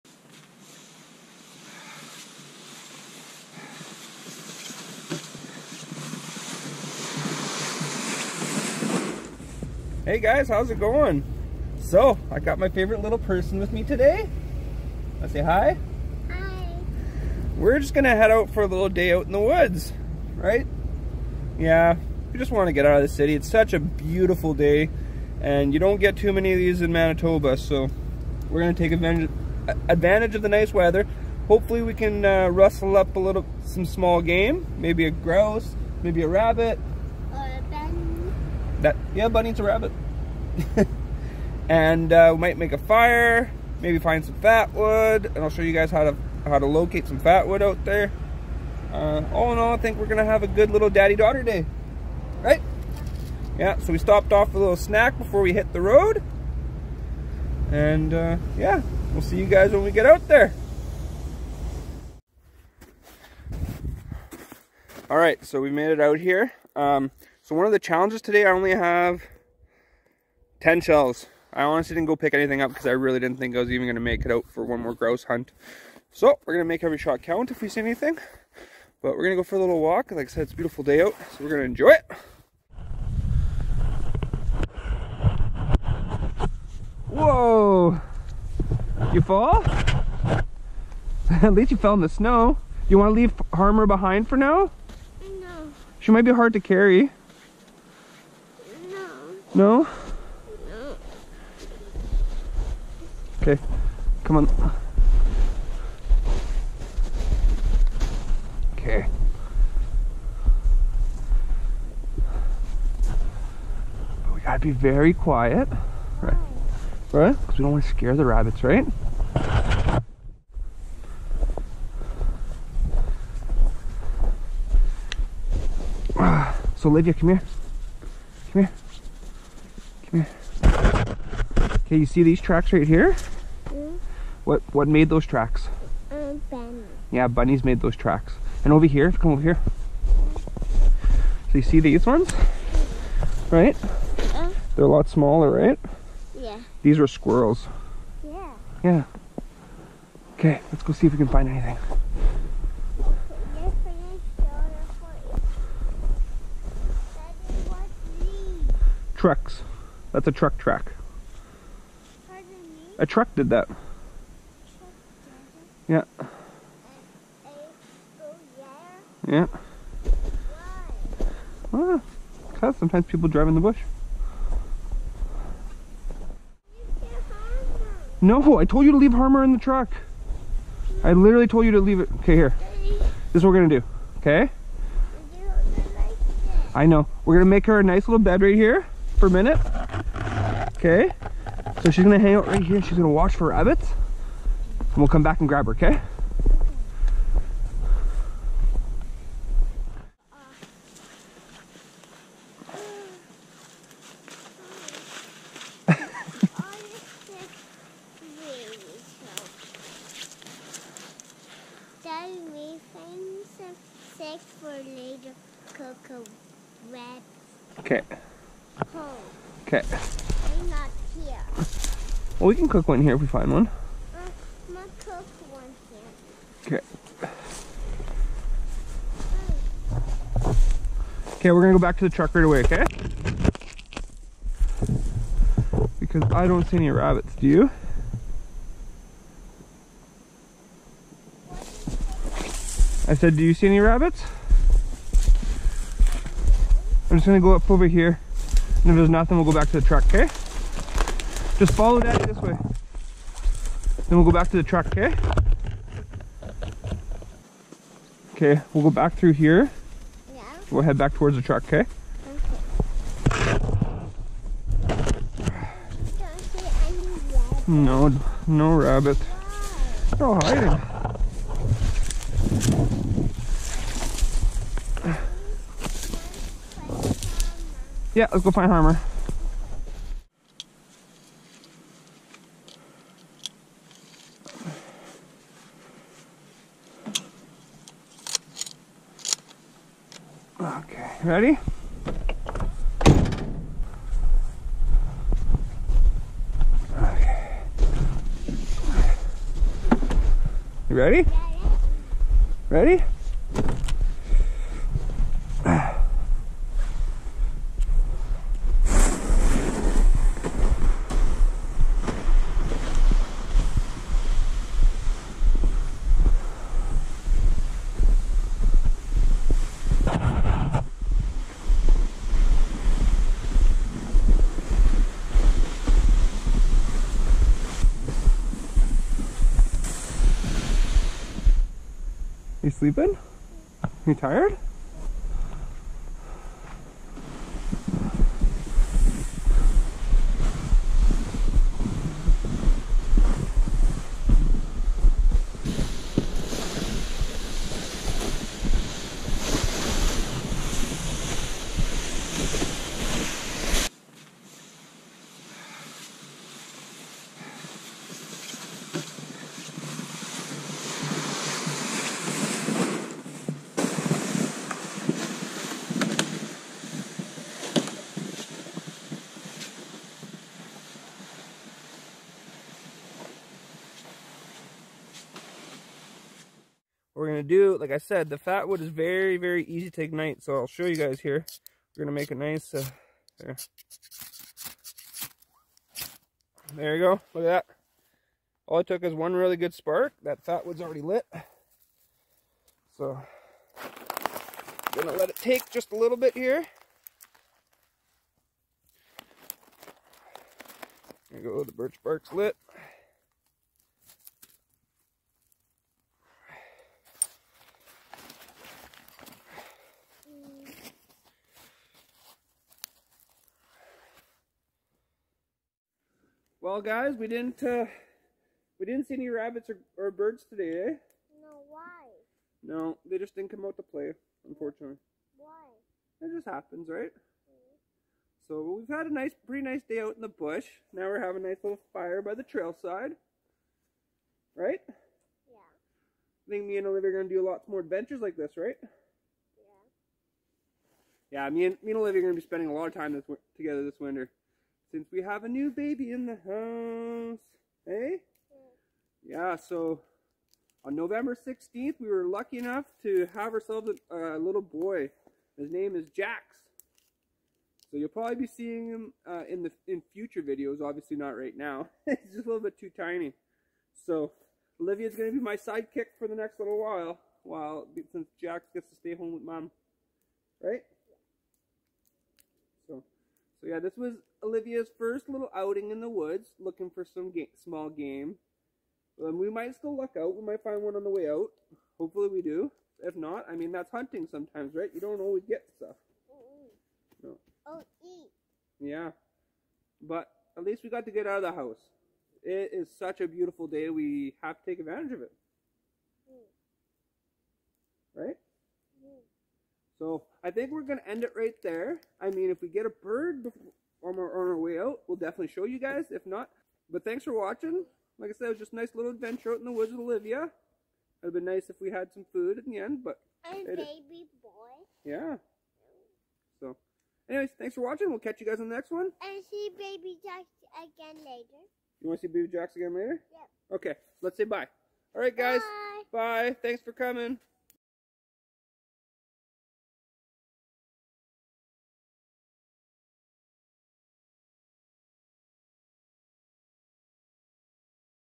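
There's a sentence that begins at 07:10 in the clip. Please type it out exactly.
Now we're having a nice little fire by the trail side.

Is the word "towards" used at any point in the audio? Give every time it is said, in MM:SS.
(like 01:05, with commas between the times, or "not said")
04:21.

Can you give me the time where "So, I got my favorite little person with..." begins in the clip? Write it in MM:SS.
00:11.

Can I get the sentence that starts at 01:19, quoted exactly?
But we're going to go for a little walk.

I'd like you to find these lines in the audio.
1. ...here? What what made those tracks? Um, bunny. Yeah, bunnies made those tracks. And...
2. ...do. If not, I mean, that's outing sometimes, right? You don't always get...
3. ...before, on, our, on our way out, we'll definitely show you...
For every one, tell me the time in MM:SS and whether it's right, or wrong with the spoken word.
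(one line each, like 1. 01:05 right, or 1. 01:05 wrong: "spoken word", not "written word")
1. 02:12 right
2. 08:02 wrong: "hunting", not "outing"
3. 08:23 right.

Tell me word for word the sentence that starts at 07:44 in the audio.
So Olivia's going to be my sidekick for the next little while, while since Jax gets to stay home with mom.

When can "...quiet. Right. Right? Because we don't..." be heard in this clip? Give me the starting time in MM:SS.
01:55.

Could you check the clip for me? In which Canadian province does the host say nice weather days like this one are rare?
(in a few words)
Manitoba.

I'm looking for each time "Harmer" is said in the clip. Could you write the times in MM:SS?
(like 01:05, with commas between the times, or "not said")
01:33, 02:59, 04:38.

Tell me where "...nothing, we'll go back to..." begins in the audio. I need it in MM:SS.
04:09.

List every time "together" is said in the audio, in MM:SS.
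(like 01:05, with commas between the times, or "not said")
07:23.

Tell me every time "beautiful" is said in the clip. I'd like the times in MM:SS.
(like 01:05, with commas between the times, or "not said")
00:23, 01:20, 08:13.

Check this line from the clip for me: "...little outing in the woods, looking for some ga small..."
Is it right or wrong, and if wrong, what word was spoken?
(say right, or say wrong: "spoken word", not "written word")
right.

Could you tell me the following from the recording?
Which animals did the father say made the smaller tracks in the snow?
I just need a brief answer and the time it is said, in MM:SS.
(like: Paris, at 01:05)
squirrels, at 02:27.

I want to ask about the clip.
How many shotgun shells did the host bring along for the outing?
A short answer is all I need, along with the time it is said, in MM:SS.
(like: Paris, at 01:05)
10, at 01:10.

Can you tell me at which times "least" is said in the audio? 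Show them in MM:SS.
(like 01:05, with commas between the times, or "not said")
01:31, 08:10.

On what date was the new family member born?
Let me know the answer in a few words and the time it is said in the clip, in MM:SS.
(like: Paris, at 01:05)
November 16th, at 07:30.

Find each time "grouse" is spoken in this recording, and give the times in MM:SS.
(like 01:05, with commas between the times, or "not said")
00:35, 01:14.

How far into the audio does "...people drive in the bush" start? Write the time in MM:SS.
02:53.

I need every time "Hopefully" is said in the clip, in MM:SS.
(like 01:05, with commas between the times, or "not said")
00:31, 08:01.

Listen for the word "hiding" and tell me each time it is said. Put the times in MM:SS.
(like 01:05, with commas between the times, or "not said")
04:30.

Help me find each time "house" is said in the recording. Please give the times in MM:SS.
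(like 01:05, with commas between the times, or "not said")
07:26, 08:11.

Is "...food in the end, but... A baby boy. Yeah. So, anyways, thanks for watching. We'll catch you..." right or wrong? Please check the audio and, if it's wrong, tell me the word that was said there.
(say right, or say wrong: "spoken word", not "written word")
right.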